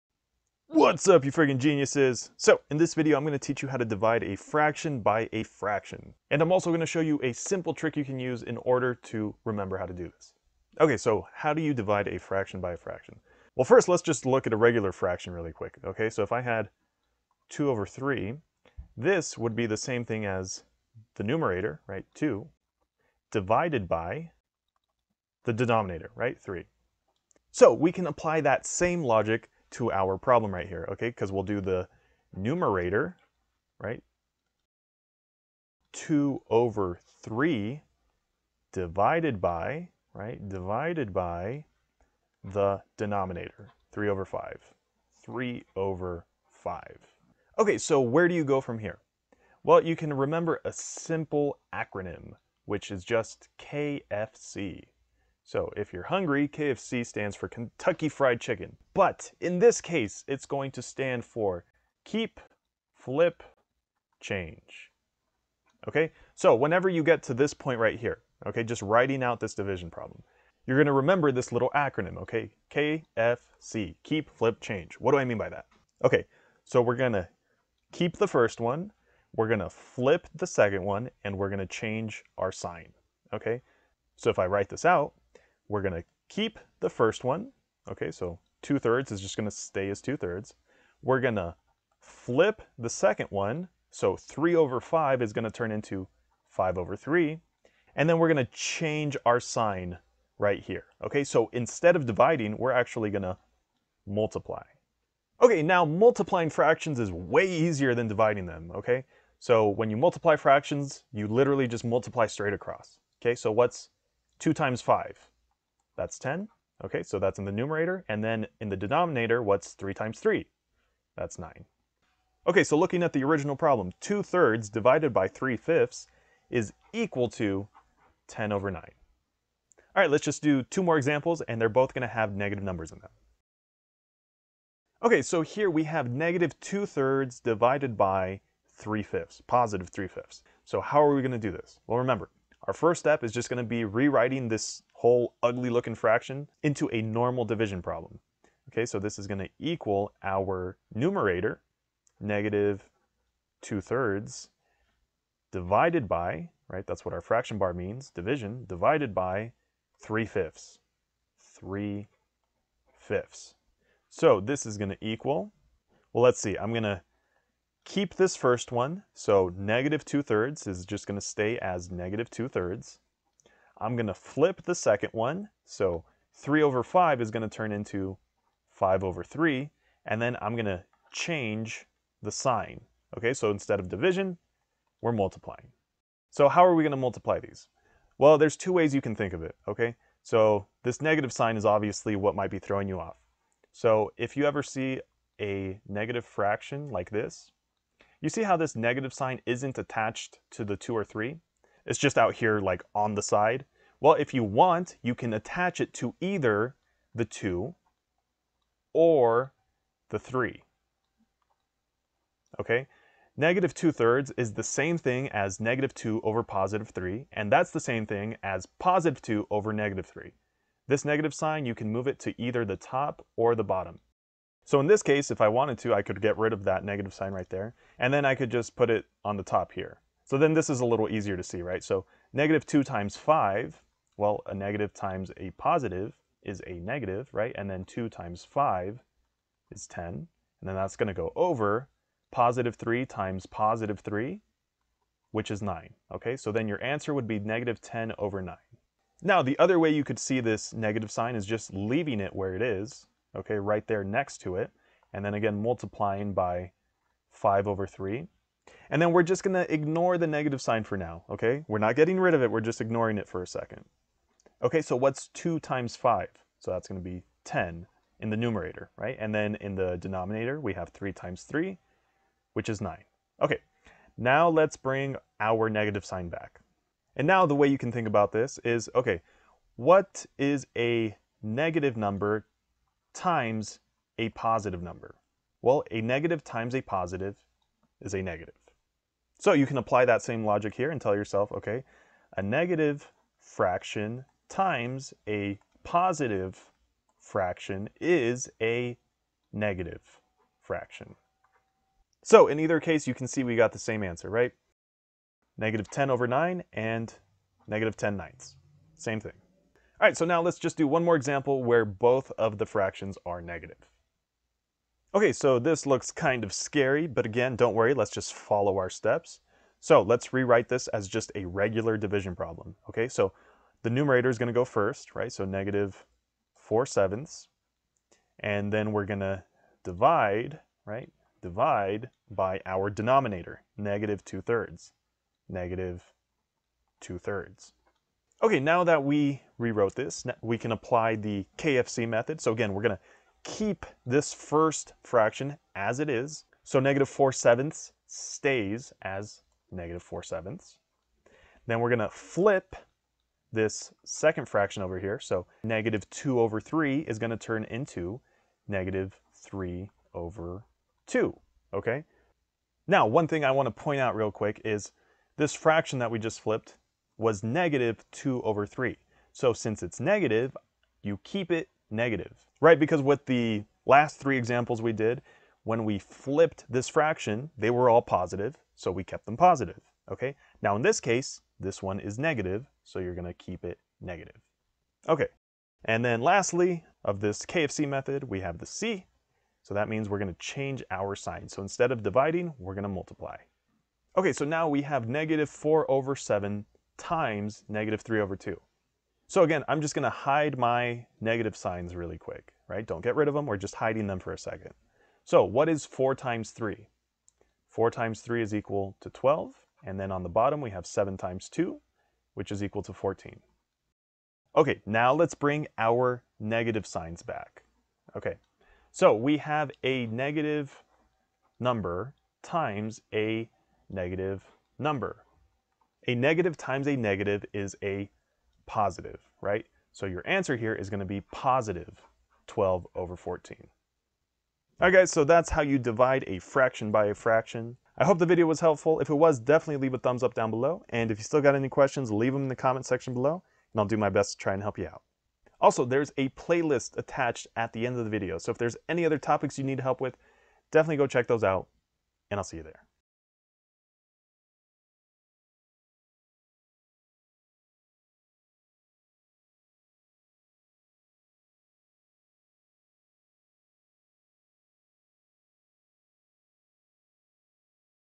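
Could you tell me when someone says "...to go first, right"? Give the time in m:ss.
5:24.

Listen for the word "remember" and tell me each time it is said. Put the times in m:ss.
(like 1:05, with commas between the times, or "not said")
0:09, 0:50, 1:10, 2:21.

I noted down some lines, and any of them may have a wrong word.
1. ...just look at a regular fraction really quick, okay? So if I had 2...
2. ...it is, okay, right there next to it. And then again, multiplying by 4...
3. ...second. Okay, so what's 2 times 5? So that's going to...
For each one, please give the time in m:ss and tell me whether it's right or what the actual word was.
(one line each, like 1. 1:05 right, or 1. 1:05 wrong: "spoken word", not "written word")
1. 0:14 right
2. 4:12 wrong: "5", not "4"
3. 4:23 right.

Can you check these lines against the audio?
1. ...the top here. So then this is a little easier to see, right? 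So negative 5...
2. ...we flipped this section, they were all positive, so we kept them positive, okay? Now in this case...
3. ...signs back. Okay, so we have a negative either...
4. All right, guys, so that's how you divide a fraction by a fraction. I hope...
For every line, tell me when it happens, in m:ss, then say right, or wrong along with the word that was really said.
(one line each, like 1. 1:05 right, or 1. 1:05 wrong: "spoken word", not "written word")
1. 3:49 wrong: "2", not "5"
2. 6:15 wrong: "fraction", not "section"
3. 6:56 wrong: "number", not "either"
4. 7:14 right.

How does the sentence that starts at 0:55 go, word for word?
So if you're hungry, KFC stands for Kentucky Fried Chicken.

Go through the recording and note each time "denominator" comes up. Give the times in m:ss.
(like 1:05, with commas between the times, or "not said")
0:25, 0:42, 1:58, 4:29, 5:32.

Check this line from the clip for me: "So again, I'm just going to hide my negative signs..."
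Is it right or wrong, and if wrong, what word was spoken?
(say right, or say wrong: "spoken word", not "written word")
right.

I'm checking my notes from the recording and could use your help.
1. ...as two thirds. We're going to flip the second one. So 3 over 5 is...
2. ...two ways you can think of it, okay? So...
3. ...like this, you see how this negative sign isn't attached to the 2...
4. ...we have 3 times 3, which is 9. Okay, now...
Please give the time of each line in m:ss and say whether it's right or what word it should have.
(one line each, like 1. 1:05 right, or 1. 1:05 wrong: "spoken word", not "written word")
1. 1:29 right
2. 3:08 right
3. 3:16 right
4. 4:30 right.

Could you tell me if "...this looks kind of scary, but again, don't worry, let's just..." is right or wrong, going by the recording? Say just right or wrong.
right.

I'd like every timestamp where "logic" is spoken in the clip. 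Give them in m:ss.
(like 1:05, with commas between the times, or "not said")
0:29, 4:50.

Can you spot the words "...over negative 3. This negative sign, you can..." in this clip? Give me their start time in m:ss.
3:39.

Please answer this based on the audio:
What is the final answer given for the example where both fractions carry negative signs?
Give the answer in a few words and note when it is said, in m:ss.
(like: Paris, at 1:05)
positive 12 over 14, at 7:11.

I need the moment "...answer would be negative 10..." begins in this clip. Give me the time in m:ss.
4:06.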